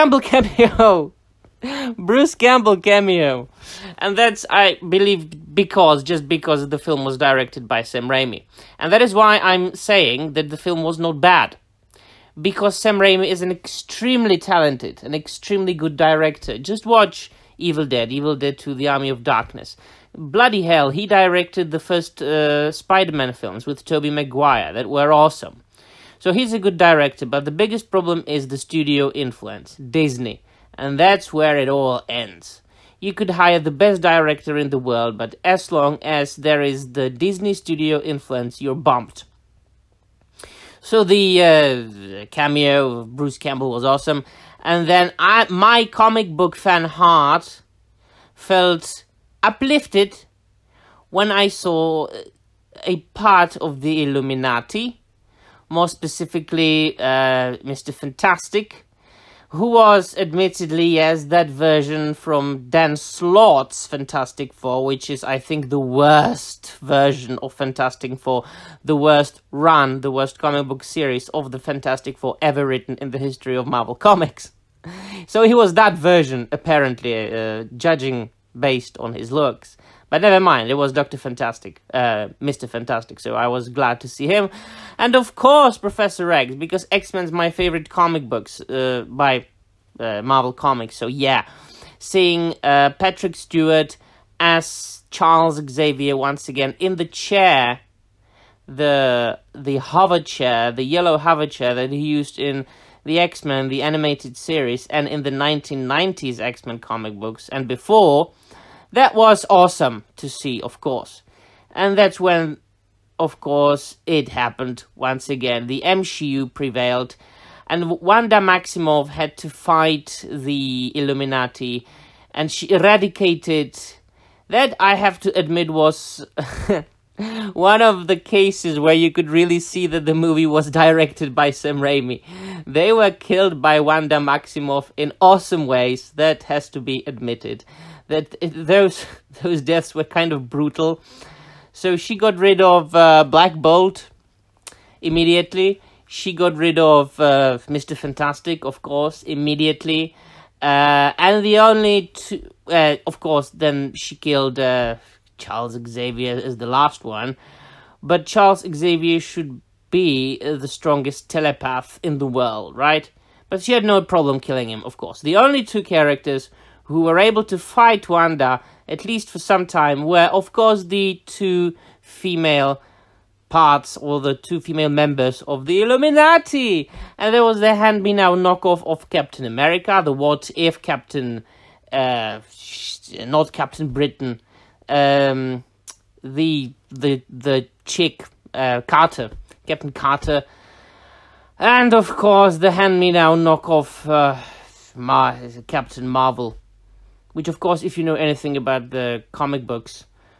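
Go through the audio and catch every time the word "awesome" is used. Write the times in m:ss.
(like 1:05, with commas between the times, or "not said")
0:25, 0:43, 1:49, 2:15.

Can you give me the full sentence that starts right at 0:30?
And that's where it all ends.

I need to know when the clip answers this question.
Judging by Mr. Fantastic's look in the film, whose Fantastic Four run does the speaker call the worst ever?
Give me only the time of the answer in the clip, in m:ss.
1:02.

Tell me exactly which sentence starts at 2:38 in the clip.
But Charles Xavier should be uh, the strongest telepath in the world, right?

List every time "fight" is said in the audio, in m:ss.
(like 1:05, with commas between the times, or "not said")
1:59, 2:47.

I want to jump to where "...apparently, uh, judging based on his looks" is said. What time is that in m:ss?
1:16.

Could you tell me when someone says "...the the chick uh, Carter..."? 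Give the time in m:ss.
3:06.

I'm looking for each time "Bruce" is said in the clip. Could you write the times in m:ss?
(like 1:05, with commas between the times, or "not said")
0:01, 0:43.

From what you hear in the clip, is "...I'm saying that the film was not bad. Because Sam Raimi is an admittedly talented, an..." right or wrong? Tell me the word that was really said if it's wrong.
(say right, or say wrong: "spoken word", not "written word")
wrong: "extremely", not "admittedly".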